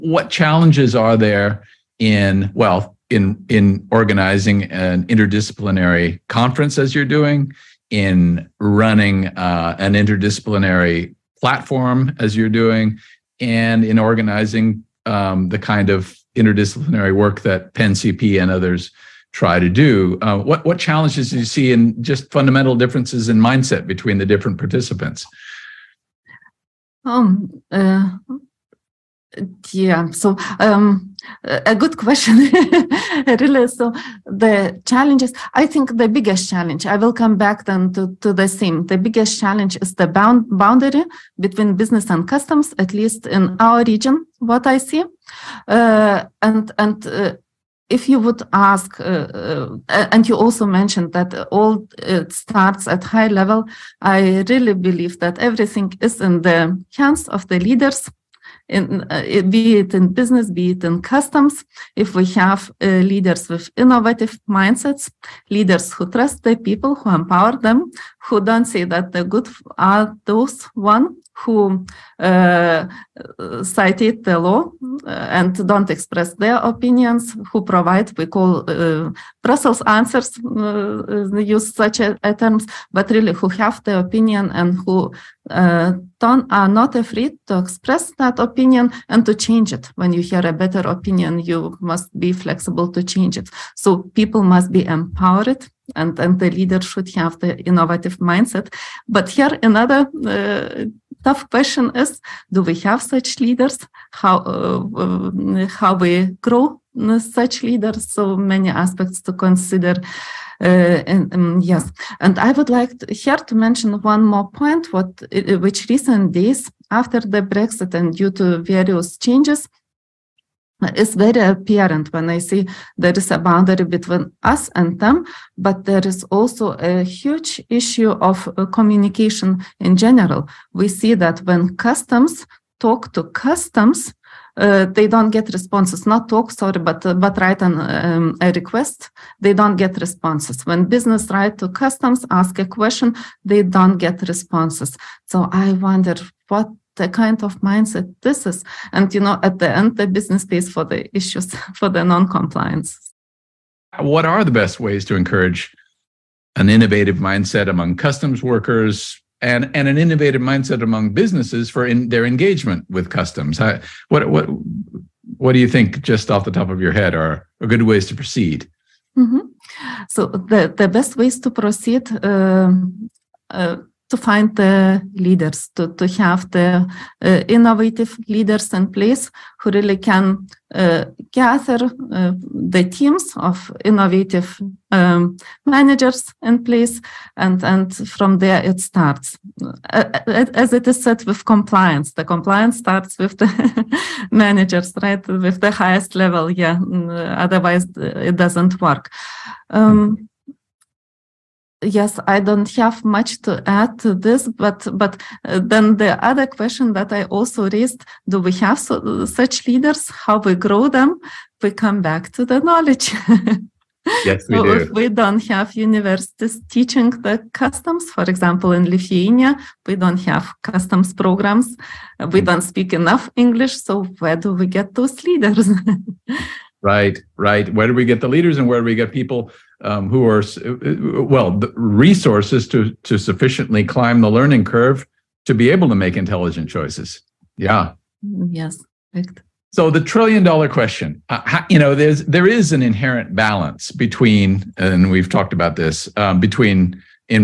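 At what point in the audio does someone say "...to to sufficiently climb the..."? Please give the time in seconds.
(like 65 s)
232 s.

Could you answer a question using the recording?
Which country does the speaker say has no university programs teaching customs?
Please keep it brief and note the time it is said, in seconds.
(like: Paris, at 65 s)
Lithuania, at 218 s.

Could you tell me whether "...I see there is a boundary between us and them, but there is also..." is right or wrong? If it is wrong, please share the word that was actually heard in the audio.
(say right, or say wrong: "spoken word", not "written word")
right.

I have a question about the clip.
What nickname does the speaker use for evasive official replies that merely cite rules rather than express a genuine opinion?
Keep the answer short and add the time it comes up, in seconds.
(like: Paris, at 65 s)
Brussels answers, at 79 s.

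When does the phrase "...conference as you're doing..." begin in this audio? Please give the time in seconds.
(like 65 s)
6 s.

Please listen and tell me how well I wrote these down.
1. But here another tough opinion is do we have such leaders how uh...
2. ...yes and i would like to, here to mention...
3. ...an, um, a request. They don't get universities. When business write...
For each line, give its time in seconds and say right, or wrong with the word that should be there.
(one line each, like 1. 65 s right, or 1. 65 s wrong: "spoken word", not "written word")
1. 99 s wrong: "question", not "opinion"
2. 111 s right
3. 137 s wrong: "responses", not "universities".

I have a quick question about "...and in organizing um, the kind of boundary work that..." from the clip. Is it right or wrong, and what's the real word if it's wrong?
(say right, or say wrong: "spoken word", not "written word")
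wrong: "interdisciplinary", not "boundary".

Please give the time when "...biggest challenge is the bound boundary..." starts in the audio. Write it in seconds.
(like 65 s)
38 s.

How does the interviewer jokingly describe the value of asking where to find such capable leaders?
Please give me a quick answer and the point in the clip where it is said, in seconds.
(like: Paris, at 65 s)
trillion dollar question, at 240 s.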